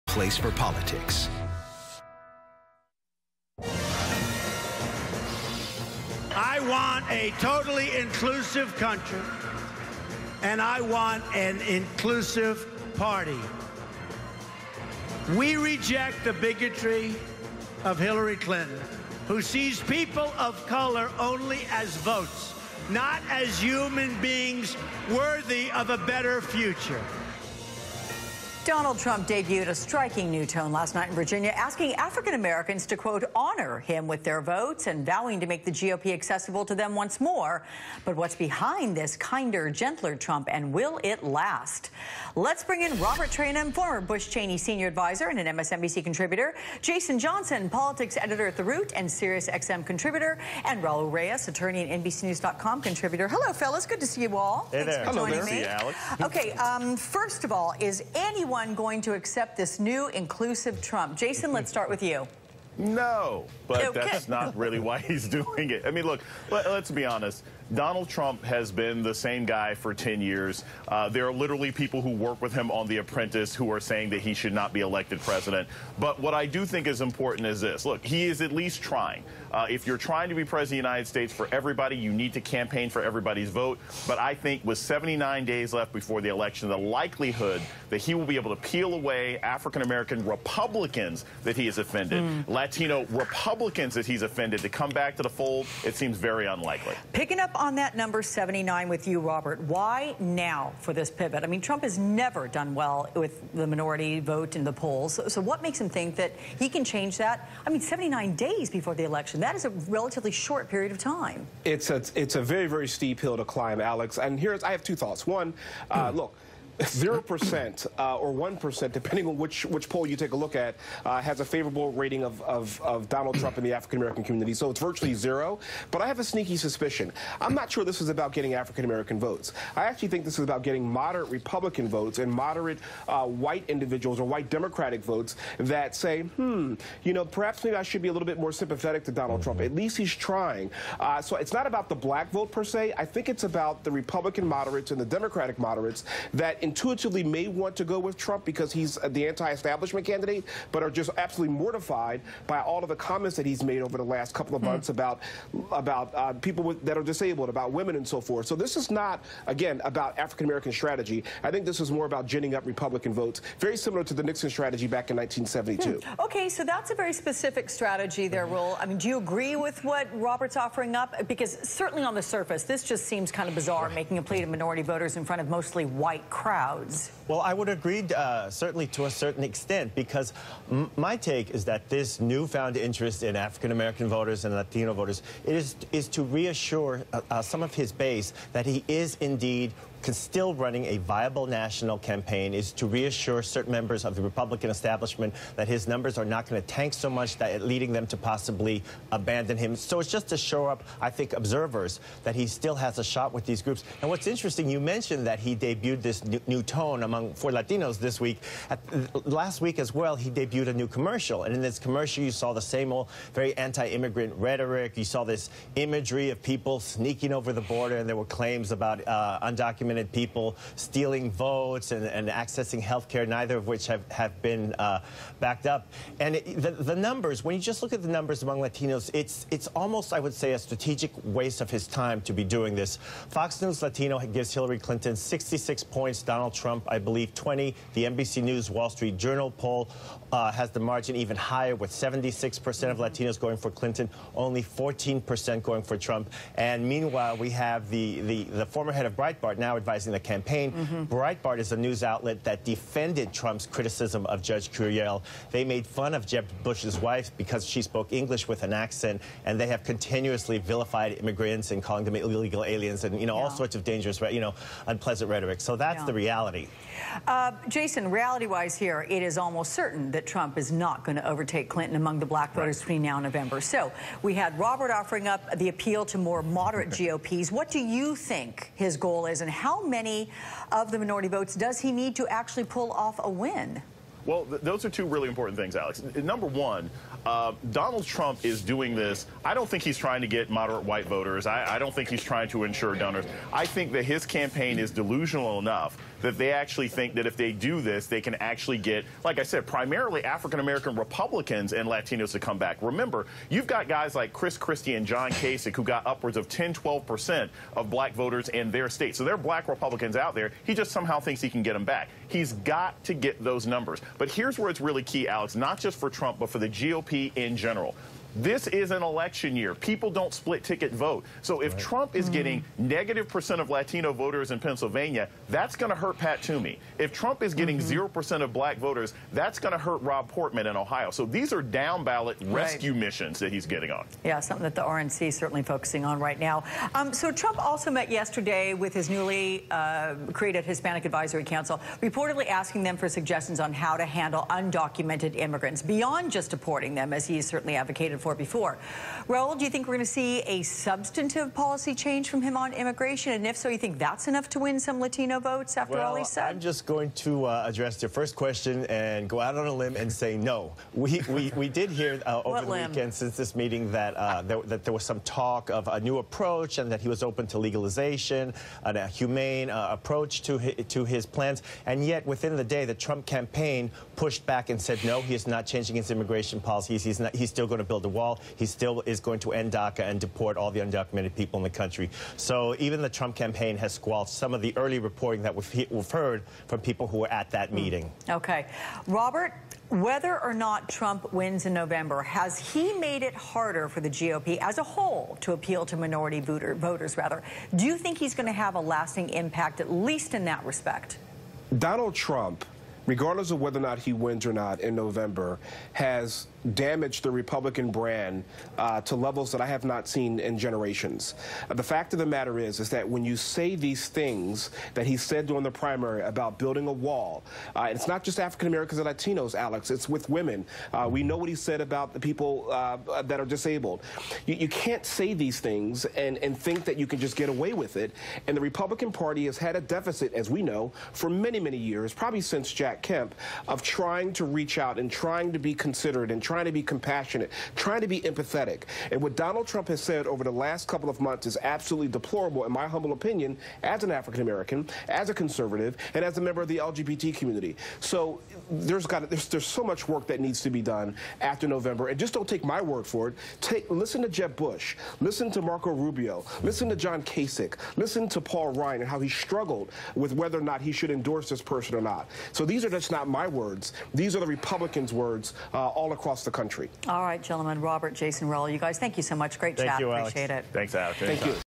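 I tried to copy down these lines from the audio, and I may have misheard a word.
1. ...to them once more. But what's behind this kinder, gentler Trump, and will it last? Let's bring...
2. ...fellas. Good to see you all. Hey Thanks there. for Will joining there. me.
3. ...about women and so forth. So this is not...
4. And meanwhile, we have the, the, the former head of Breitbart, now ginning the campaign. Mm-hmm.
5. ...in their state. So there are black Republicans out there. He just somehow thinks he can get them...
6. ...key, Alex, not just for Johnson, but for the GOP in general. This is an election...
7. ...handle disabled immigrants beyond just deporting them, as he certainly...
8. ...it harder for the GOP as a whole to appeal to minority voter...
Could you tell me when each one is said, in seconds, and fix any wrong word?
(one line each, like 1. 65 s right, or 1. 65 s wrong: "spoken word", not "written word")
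1. 36 s right
2. 53 s wrong: "Hello", not "Will"
3. 157 s right
4. 246 s wrong: "advising", not "ginning"
5. 308 s right
6. 315 s wrong: "Trump", not "Johnson"
7. 344 s wrong: "undocumented", not "disabled"
8. 393 s right.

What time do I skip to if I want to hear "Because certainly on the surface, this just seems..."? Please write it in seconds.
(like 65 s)
171 s.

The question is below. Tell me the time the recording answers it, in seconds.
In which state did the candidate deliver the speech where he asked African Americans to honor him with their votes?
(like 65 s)
31 s.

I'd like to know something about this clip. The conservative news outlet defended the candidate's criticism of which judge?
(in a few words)
Judge Curiel.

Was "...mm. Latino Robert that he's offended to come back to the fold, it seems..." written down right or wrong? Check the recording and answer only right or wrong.
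wrong.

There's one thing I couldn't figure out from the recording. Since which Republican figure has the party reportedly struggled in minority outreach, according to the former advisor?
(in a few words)
Jack Kemp.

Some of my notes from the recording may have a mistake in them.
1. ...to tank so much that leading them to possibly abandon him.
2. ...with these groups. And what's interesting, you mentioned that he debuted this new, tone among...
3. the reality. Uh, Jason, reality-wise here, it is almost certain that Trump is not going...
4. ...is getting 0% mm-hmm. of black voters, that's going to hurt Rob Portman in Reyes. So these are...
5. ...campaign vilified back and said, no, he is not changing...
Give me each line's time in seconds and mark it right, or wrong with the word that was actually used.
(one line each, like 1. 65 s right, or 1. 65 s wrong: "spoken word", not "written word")
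1. 196 s right
2. 203 s right
3. 266 s right
4. 327 s wrong: "Ohio", not "Reyes"
5. 373 s wrong: "pushed", not "vilified".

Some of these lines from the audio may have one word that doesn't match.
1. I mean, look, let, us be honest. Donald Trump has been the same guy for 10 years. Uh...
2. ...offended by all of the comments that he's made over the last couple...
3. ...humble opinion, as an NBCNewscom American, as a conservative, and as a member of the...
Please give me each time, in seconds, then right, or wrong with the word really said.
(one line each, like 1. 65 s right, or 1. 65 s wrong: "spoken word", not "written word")
1. 65 s right
2. 151 s wrong: "mortified", not "offended"
3. 442 s wrong: "African", not "NBCNewscom".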